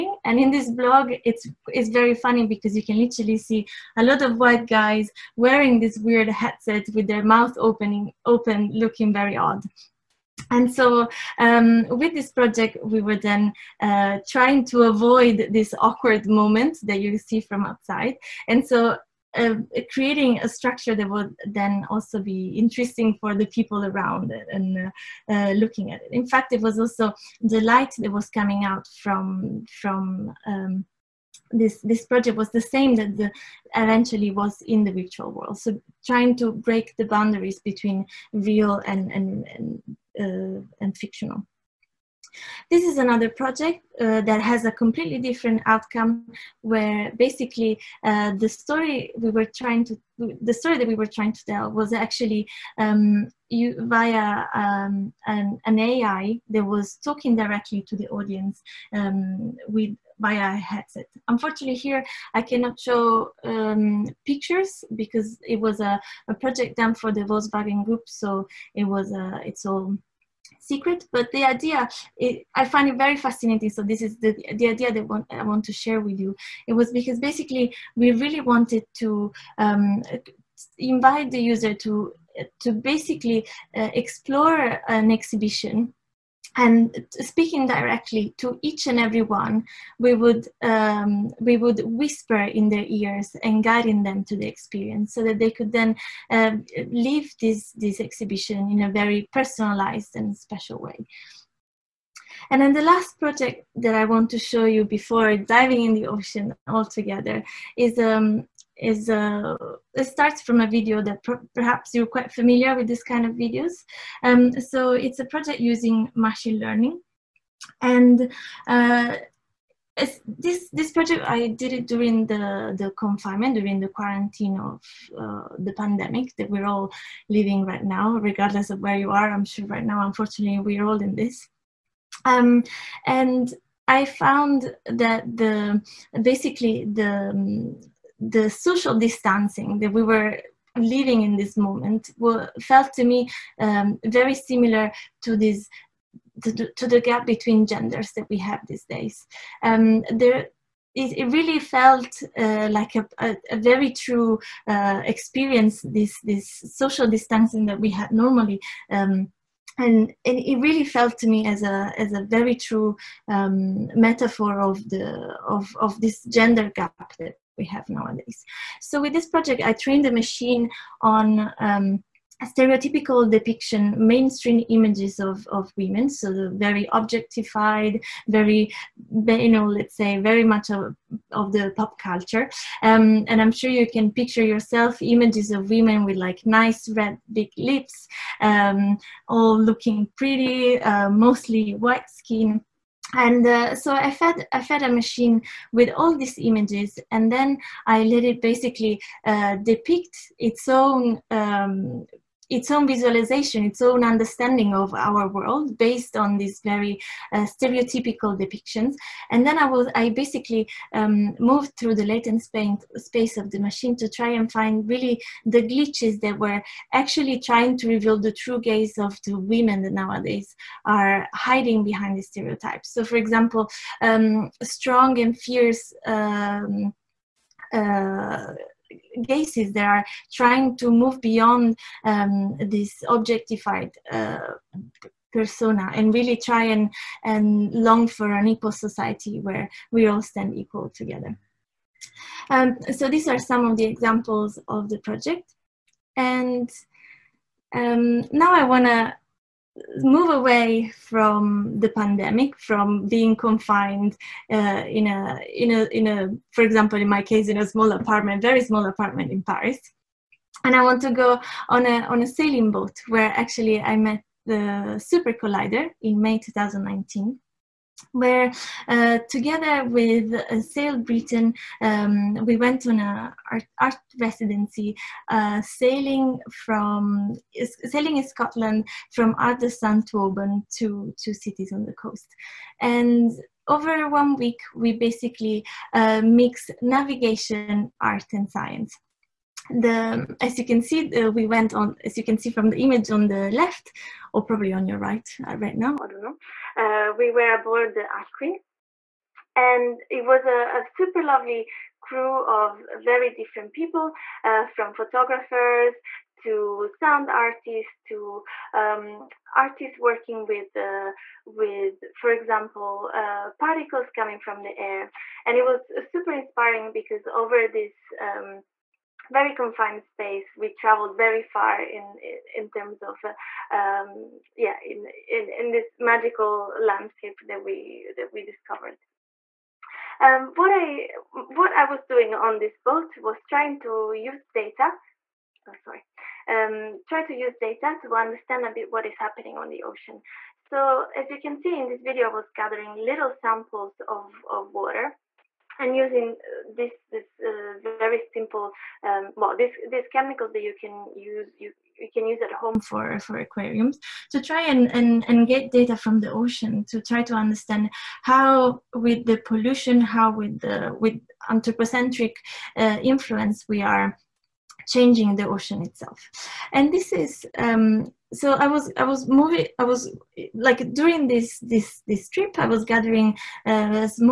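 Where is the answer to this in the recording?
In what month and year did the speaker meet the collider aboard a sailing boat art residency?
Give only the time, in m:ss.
4:26.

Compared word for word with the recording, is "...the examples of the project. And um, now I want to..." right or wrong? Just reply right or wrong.
right.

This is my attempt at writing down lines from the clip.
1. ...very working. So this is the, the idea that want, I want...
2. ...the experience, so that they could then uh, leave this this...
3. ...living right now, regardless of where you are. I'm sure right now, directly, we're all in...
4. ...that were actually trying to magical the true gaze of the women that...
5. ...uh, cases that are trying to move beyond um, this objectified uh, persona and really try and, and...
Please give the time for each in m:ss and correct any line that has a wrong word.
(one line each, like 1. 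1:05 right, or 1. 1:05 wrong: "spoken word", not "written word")
1. 1:12 wrong: "fascinating", not "working"
2. 1:34 right
3. 2:07 wrong: "unfortunately", not "directly"
4. 3:36 wrong: "reveal", not "magical"
5. 3:47 right.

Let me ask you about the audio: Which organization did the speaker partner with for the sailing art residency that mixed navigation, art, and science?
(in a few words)
Sail Britain.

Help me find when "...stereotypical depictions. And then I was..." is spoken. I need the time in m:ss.
3:27.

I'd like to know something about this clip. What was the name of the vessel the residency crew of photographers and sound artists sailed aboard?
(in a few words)
Art Queen.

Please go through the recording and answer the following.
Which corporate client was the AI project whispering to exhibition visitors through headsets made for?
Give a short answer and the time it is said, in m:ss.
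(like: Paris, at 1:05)
Volkswagen Group, at 1:07.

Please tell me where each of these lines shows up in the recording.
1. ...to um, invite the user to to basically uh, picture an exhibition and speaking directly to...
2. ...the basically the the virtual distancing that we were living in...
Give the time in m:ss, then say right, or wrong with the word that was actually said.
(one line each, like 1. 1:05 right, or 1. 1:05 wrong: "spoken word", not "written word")
1. 1:18 wrong: "explore", not "picture"
2. 2:15 wrong: "social", not "virtual".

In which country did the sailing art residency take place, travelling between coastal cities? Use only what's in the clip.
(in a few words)
Scotland.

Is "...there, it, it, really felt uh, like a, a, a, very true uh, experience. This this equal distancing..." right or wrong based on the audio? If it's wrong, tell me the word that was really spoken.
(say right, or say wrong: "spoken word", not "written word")
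wrong: "social", not "equal".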